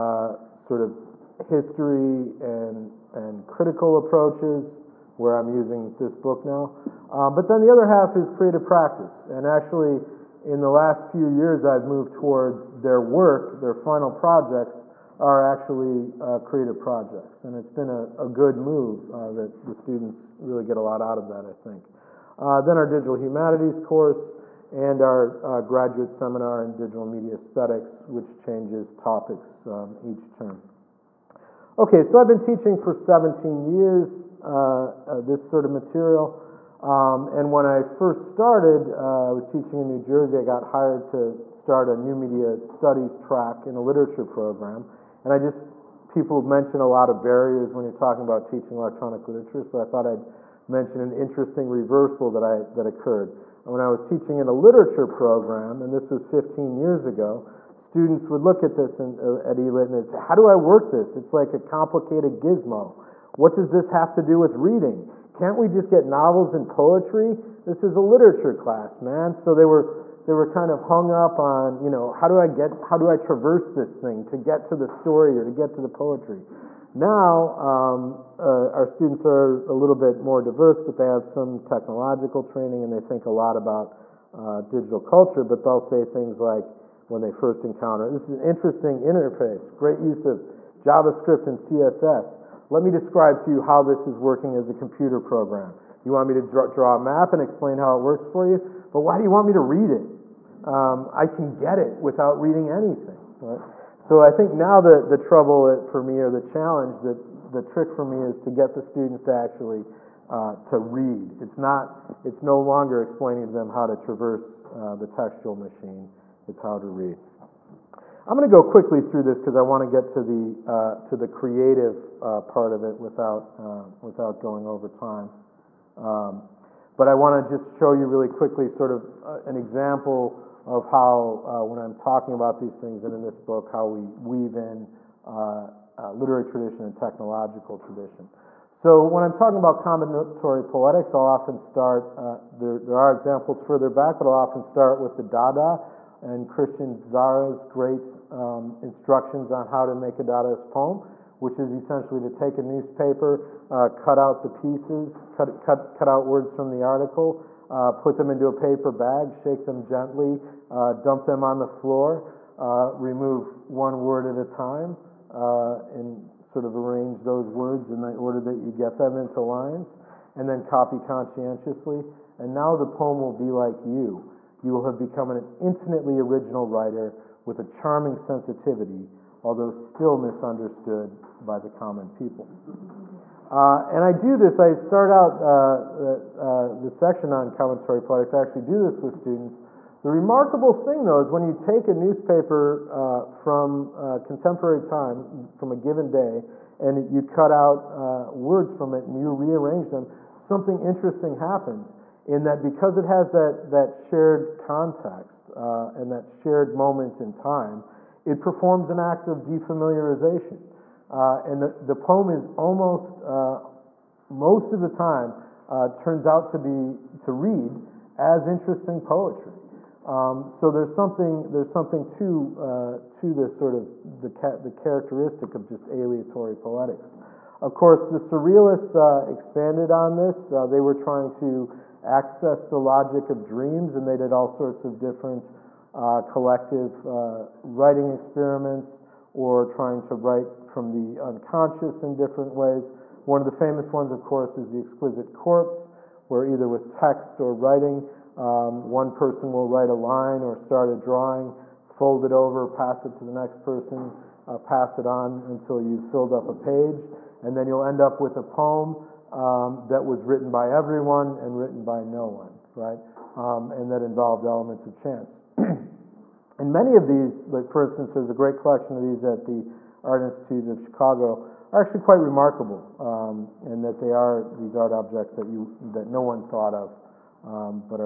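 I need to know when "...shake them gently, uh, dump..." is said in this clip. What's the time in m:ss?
2:39.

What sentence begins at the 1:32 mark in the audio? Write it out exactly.
Let me describe to you how this is working as a computer program.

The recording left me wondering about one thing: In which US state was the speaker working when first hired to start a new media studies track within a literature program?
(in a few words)
New Jersey.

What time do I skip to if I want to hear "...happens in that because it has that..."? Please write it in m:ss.
3:21.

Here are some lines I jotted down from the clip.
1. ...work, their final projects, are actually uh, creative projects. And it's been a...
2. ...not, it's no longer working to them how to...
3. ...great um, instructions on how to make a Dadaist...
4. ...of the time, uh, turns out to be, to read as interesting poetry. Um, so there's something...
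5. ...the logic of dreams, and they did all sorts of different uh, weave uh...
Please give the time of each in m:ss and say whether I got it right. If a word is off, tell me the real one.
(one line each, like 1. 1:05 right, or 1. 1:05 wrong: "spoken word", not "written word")
1. 0:12 right
2. 1:51 wrong: "explaining", not "working"
3. 2:27 right
4. 3:34 right
5. 3:52 wrong: "collective", not "weave".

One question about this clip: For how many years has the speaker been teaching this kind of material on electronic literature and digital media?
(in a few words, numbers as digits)
17.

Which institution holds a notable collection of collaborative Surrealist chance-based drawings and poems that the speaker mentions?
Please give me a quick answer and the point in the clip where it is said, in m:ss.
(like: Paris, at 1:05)
Art Institute of Chicago, at 4:30.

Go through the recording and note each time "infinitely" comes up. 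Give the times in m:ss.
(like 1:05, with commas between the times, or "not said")
2:55.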